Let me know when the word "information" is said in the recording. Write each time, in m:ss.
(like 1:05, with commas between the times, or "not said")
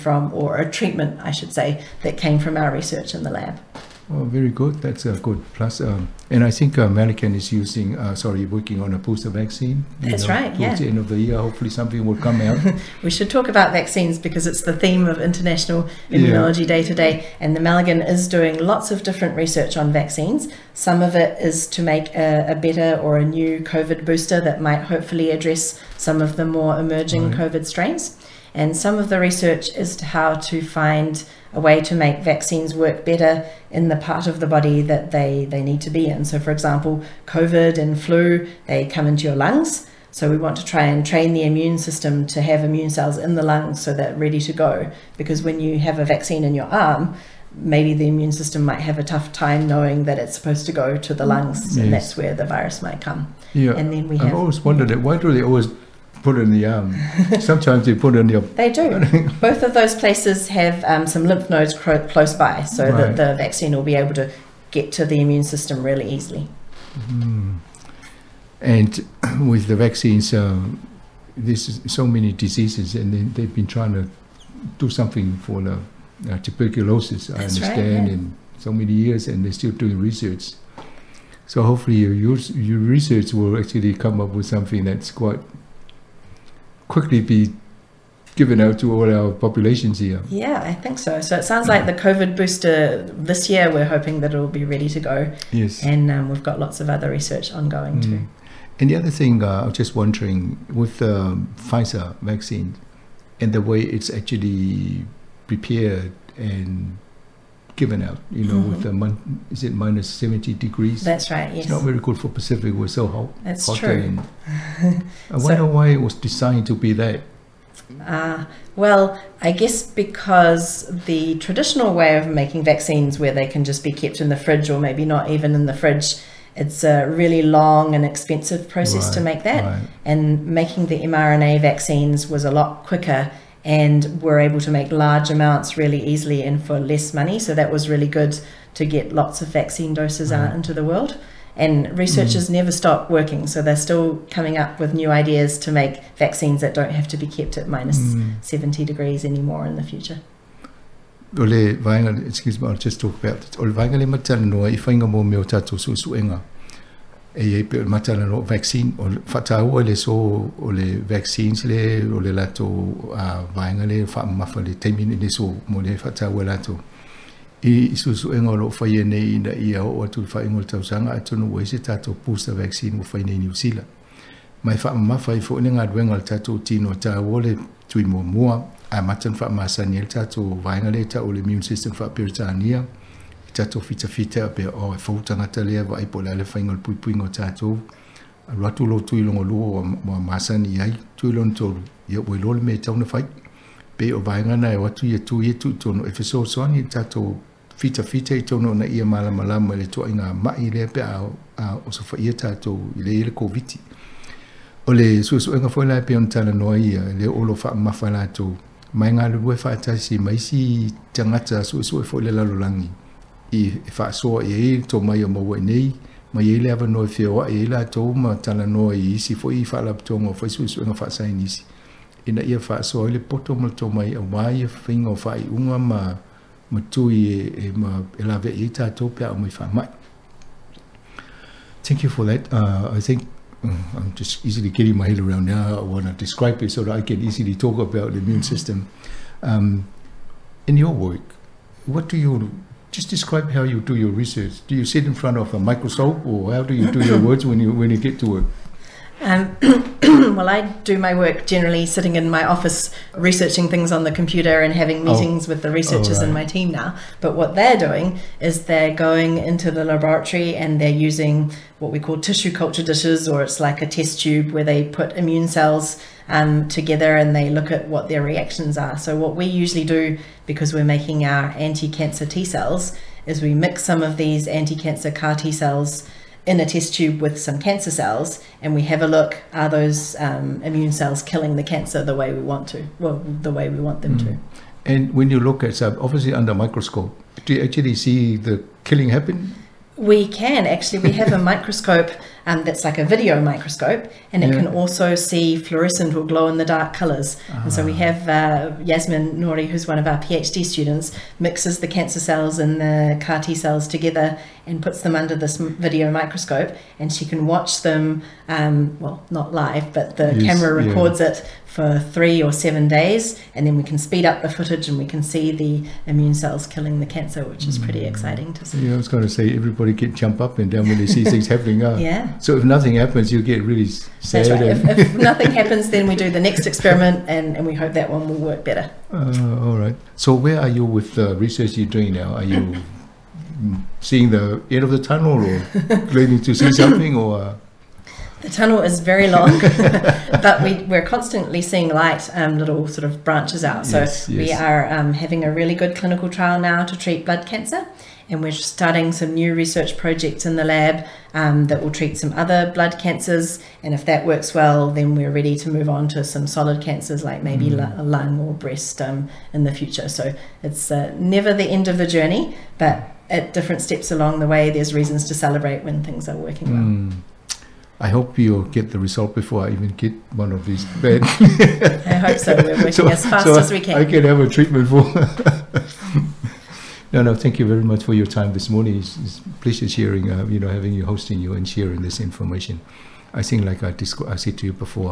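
6:22.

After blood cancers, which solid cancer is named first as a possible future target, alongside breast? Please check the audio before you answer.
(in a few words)
Lung.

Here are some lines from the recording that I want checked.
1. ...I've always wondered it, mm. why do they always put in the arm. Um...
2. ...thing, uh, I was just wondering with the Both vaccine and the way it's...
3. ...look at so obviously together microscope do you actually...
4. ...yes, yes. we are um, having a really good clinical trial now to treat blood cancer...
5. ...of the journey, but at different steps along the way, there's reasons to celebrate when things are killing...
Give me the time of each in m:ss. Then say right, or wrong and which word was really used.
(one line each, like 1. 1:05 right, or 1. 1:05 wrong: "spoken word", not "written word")
1. 0:54 right
2. 1:39 wrong: "Pfizer", not "Both"
3. 4:45 wrong: "under", not "together"
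4. 5:43 right
5. 6:01 wrong: "working", not "killing".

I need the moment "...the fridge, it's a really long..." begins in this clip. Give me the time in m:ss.
2:05.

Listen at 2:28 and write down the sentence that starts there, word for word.
70 degrees anymore in the future.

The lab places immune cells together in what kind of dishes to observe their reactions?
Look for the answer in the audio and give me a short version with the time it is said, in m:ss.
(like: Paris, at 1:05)
Tissue culture dishes, at 4:22.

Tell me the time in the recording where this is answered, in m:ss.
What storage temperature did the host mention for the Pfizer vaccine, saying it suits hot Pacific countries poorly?
1:49.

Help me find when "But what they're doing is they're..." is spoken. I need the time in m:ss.
4:17.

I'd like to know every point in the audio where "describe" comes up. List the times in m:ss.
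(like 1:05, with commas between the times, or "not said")
3:56, 4:03.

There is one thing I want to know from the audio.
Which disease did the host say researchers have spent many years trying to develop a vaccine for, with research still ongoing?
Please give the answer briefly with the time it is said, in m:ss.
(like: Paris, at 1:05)
Tuberculosis, at 1:16.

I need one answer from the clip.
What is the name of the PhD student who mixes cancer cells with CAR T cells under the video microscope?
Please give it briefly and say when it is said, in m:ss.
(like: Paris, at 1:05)
Yasmin Nouri, at 4:58.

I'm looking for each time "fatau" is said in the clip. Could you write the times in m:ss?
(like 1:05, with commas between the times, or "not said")
2:39, 2:45.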